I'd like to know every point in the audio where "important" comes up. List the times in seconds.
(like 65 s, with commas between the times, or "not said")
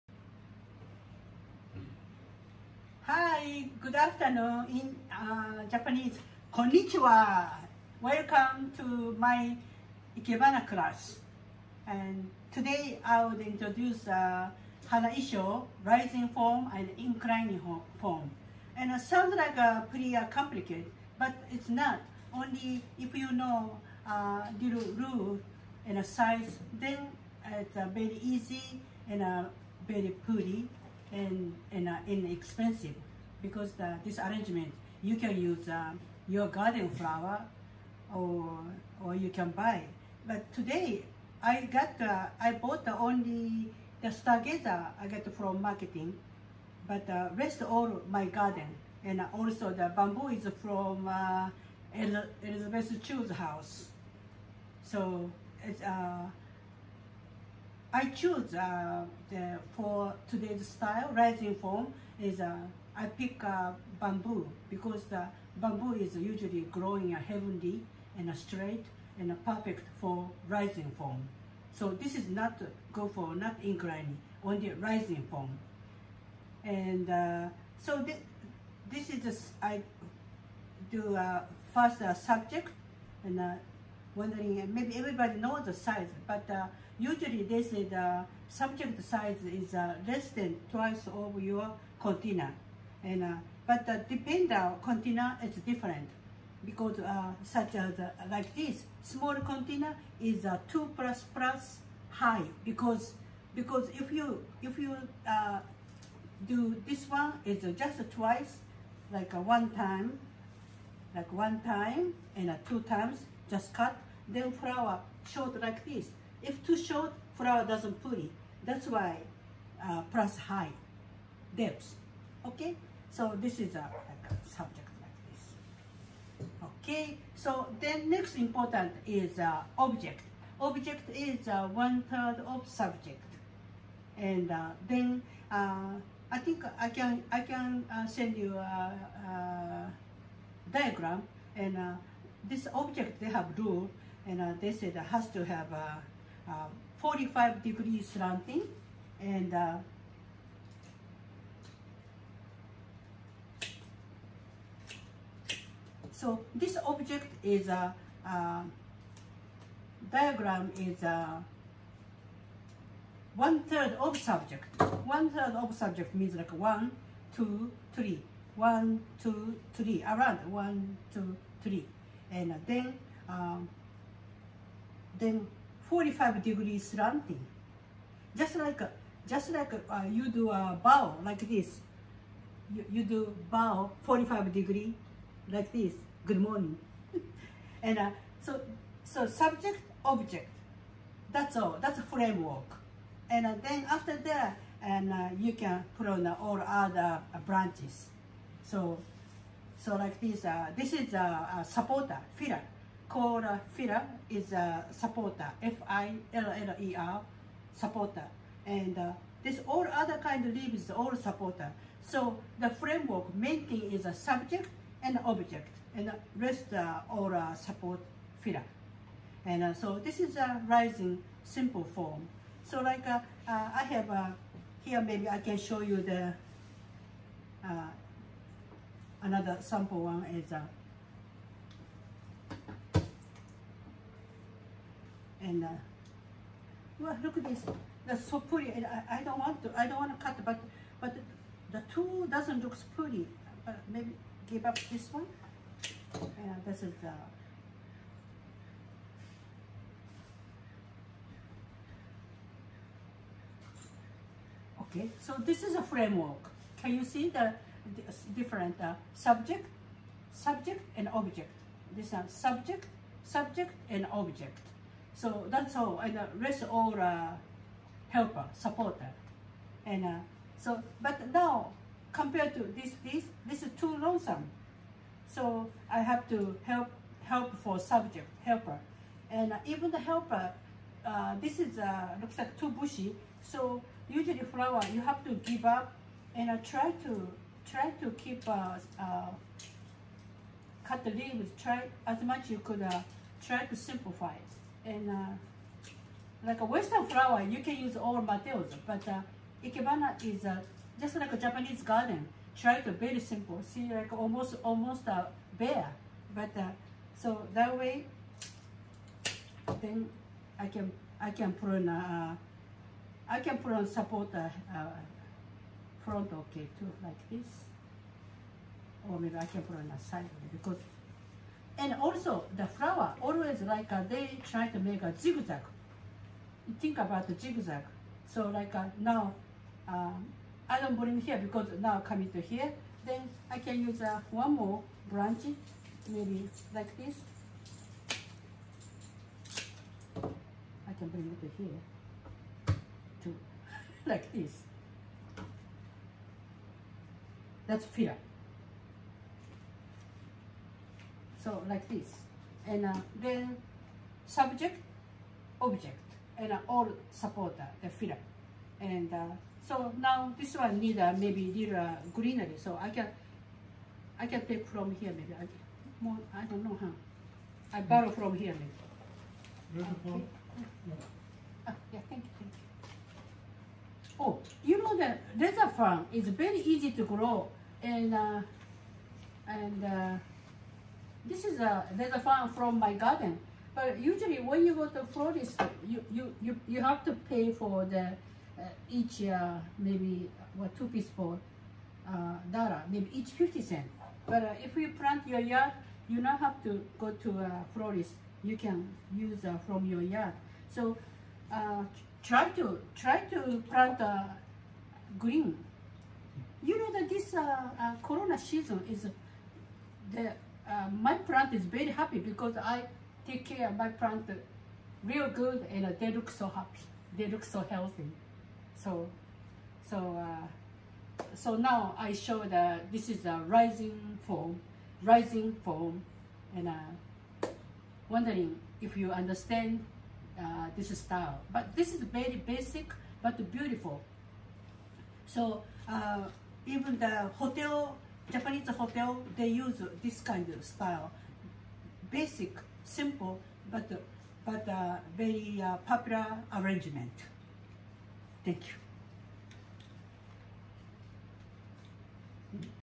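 128 s.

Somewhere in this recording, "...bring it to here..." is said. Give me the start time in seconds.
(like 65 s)
341 s.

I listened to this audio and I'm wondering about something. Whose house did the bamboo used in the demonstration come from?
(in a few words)
Elizabeth Chu.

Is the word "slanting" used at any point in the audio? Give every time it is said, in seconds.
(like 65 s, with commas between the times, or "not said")
148 s, 176 s.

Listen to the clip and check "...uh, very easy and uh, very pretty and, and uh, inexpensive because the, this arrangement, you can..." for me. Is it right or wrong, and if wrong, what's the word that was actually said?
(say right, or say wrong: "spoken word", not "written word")
right.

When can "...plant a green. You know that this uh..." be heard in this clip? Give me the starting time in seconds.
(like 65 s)
403 s.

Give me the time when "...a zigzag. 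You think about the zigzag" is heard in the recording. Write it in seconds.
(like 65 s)
325 s.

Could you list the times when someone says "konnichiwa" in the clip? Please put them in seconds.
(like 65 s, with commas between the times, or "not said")
6 s.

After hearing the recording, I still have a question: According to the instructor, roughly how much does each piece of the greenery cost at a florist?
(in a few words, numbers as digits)
50 cents.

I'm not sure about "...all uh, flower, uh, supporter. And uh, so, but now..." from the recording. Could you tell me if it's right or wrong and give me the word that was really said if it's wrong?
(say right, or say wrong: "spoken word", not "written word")
wrong: "helper", not "flower".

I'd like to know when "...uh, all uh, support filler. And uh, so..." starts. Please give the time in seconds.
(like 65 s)
216 s.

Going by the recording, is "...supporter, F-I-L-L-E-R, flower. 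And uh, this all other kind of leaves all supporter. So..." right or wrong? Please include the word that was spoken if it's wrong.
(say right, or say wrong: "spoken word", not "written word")
wrong: "supporter", not "flower".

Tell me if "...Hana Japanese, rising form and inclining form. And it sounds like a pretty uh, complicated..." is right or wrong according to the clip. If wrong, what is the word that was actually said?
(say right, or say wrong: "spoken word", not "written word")
wrong: "Isho", not "Japanese".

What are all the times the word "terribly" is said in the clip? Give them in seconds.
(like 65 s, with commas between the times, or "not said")
not said.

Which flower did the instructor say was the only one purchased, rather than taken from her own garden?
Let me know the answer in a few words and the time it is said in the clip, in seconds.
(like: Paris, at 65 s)
Stargazer, at 44 s.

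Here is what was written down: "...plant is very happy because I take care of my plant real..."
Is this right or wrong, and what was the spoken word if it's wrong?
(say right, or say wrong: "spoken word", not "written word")
right.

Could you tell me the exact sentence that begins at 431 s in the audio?
But this is very basic but beautiful.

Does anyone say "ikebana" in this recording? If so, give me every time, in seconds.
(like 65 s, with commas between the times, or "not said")
10 s, 299 s.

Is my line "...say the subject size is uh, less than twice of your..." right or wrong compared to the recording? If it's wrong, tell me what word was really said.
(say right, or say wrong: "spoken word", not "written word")
right.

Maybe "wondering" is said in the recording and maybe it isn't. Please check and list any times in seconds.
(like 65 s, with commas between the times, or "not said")
84 s, 428 s.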